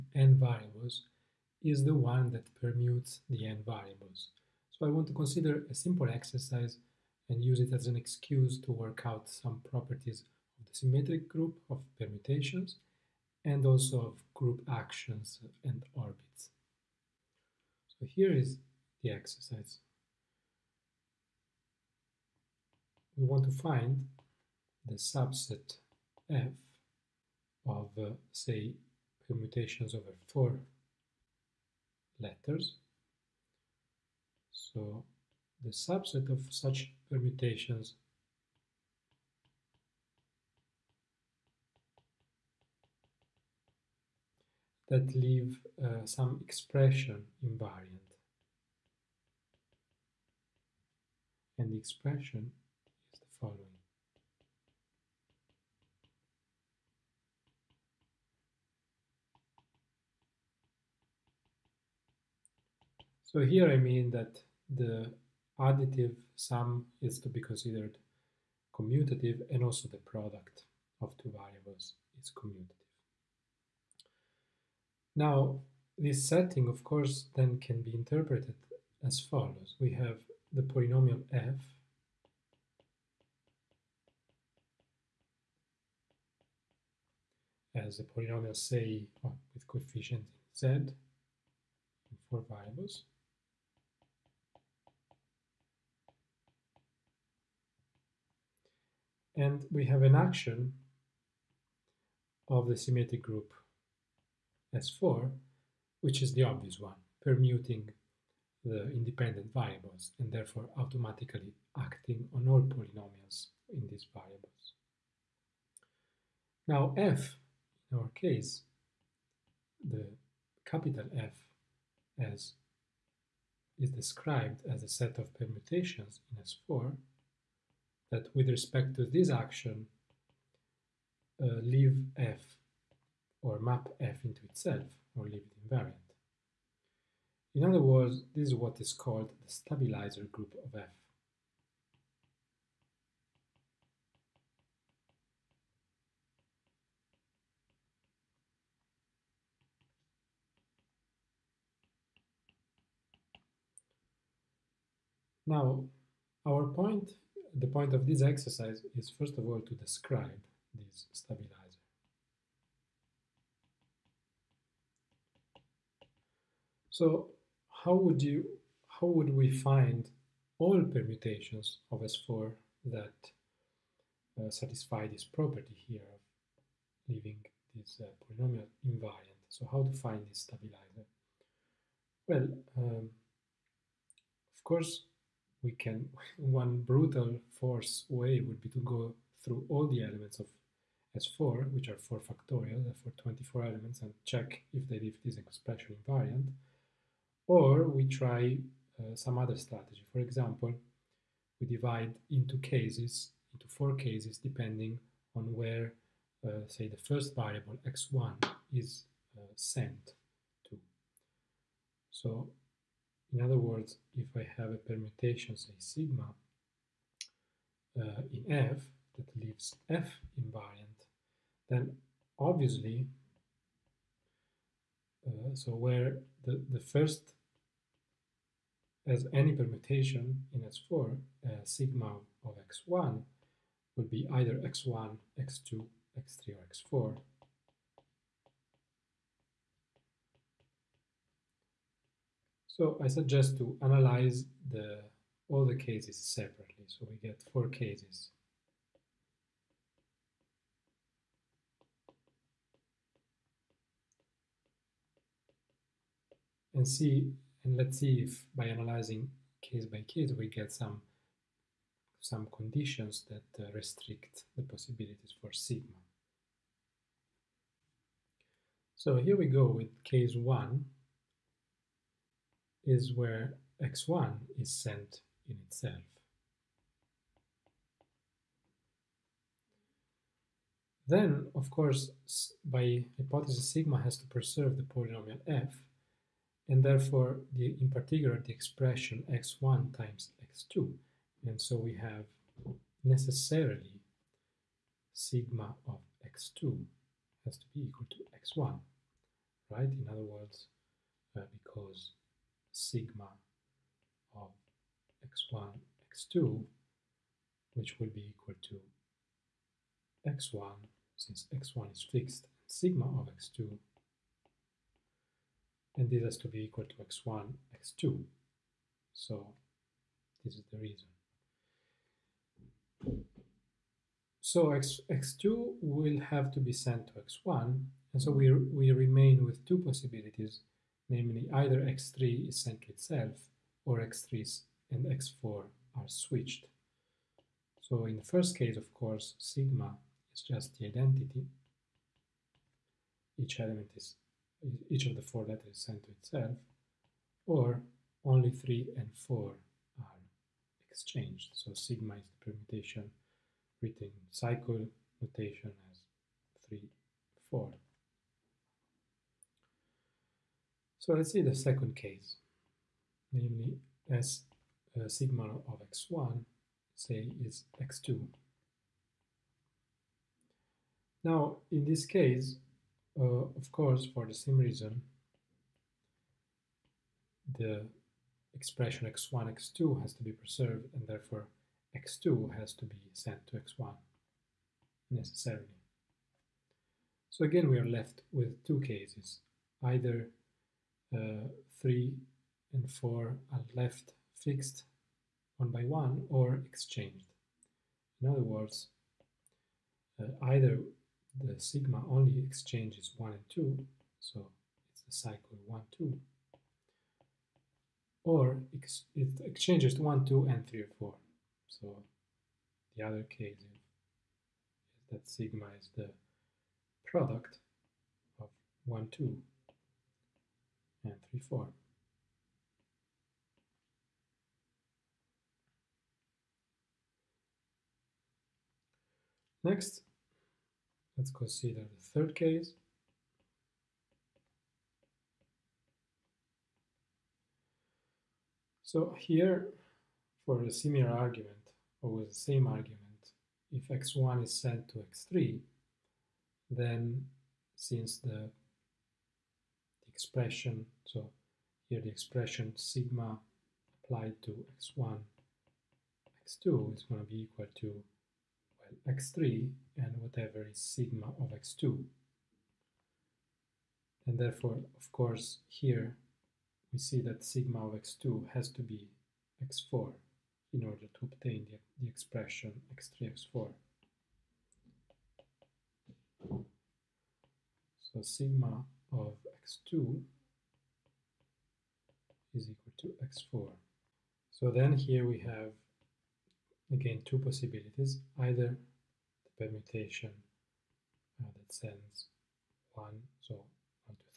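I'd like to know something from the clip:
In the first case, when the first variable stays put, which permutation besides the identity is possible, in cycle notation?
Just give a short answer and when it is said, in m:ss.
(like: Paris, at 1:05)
(3 4), at 5:56.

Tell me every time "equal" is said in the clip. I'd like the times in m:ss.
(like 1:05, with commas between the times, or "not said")
4:57, 5:08, 5:16, 7:37, 8:02.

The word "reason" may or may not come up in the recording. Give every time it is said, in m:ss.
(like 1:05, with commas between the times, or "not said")
5:20, 6:14.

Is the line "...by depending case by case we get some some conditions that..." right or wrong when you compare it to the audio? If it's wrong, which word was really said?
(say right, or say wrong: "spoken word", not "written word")
wrong: "analyzing", not "depending".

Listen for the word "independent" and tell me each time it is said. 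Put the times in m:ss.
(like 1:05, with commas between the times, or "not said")
1:48.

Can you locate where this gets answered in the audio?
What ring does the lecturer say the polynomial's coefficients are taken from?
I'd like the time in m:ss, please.
1:30.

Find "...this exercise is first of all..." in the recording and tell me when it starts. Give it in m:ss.
2:38.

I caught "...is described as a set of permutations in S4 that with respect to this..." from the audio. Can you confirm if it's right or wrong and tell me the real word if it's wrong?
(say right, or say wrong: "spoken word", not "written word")
right.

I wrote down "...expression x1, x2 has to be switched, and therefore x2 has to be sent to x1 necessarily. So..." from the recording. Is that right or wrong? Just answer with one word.
wrong.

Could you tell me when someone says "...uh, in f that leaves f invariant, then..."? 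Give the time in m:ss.
3:37.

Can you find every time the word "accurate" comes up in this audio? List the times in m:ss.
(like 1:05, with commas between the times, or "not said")
not said.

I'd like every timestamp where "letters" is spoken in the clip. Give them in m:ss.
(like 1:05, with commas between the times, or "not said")
0:32, 5:45.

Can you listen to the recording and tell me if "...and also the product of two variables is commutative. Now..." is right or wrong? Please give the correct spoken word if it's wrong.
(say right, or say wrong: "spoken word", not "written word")
right.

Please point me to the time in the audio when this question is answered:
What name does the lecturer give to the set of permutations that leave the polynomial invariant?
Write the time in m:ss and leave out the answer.
2:19.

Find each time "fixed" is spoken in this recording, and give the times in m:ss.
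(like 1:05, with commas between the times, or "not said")
5:12, 6:34.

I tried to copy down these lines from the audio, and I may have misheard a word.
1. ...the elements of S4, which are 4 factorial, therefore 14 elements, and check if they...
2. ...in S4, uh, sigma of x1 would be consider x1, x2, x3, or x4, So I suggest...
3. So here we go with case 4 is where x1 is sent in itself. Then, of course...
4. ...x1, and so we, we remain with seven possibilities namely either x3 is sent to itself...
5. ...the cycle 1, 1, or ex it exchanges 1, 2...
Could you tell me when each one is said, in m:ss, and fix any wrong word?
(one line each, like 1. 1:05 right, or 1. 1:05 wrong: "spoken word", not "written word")
1. 3:09 wrong: "24", not "14"
2. 3:50 wrong: "either", not "consider"
3. 4:28 wrong: "1", not "4"
4. 5:27 wrong: "two", not "seven"
5. 6:45 wrong: "2", not "1".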